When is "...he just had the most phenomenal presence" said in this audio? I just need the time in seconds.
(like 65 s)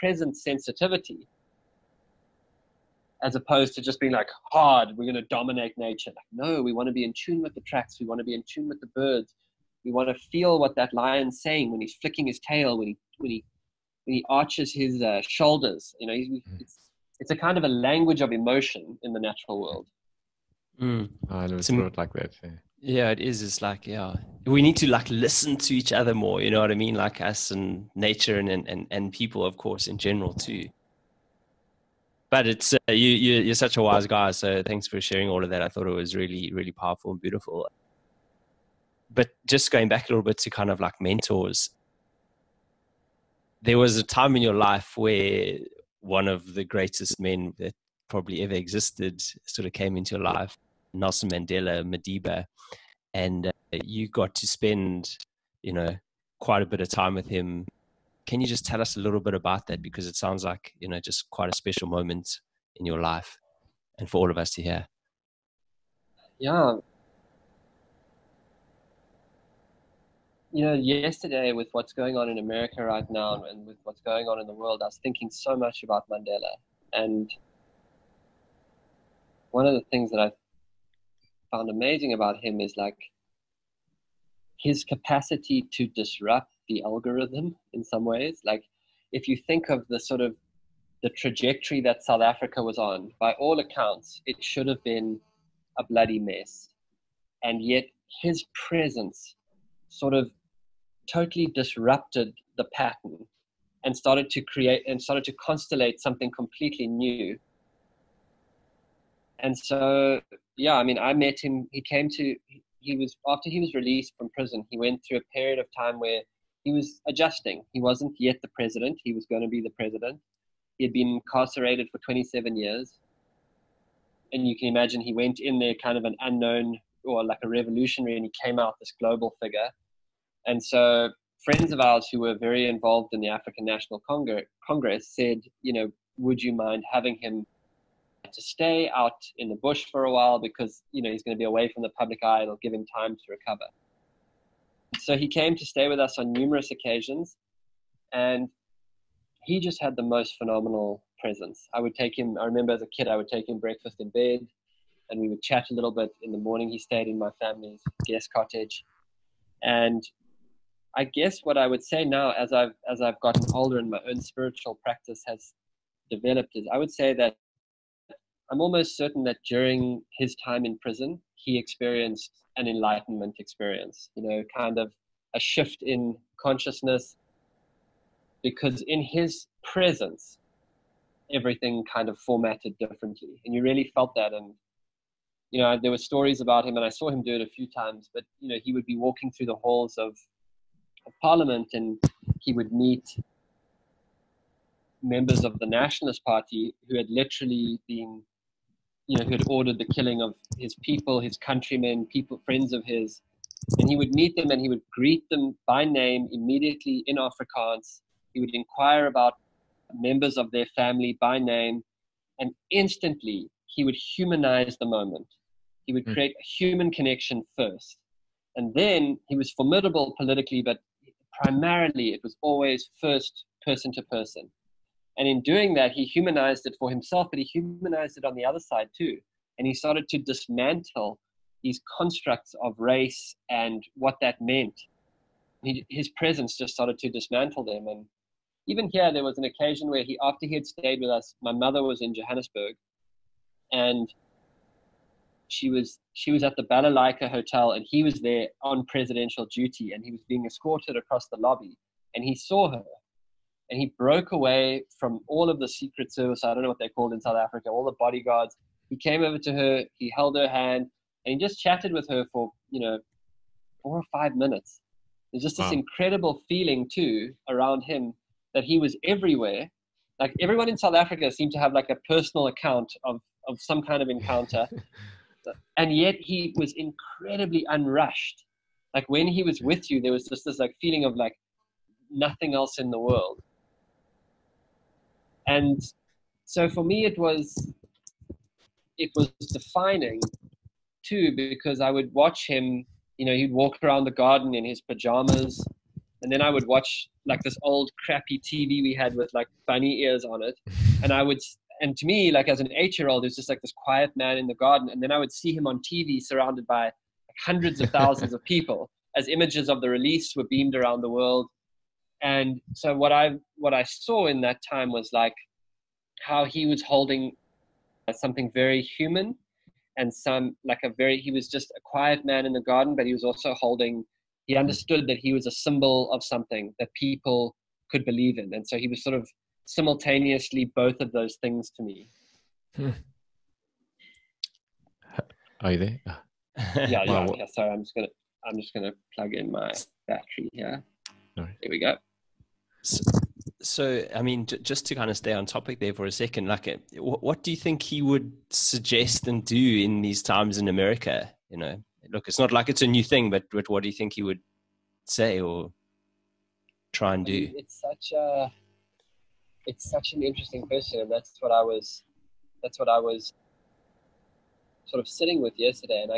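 149 s.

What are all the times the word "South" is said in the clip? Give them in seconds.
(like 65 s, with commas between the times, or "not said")
92 s, 257 s, 270 s.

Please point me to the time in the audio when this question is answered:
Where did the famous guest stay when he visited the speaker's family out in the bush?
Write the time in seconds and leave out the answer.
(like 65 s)
158 s.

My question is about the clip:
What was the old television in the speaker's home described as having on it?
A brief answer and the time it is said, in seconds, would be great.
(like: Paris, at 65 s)
bunny ears, at 299 s.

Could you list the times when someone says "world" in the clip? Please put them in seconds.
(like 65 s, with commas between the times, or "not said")
19 s, 74 s, 282 s, 311 s.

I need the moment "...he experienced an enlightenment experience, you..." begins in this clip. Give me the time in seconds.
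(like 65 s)
171 s.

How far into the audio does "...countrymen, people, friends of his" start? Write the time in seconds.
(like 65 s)
201 s.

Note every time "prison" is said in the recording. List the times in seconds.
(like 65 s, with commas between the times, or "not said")
114 s, 170 s.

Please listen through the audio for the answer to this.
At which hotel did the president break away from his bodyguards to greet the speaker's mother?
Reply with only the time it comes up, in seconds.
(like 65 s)
246 s.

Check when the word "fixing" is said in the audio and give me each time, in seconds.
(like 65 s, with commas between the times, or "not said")
not said.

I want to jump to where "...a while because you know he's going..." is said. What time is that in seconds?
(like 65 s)
140 s.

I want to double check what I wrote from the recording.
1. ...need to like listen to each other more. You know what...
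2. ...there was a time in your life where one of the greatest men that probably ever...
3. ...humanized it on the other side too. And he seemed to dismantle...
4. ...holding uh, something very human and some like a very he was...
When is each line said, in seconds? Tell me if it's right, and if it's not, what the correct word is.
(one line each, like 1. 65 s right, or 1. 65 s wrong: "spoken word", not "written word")
1. 24 s right
2. 43 s right
3. 227 s wrong: "started", not "seemed"
4. 316 s right.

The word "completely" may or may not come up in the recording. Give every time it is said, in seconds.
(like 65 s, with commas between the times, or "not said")
106 s.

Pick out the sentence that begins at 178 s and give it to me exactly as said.
Because in his presence, everything kind of formatted differently.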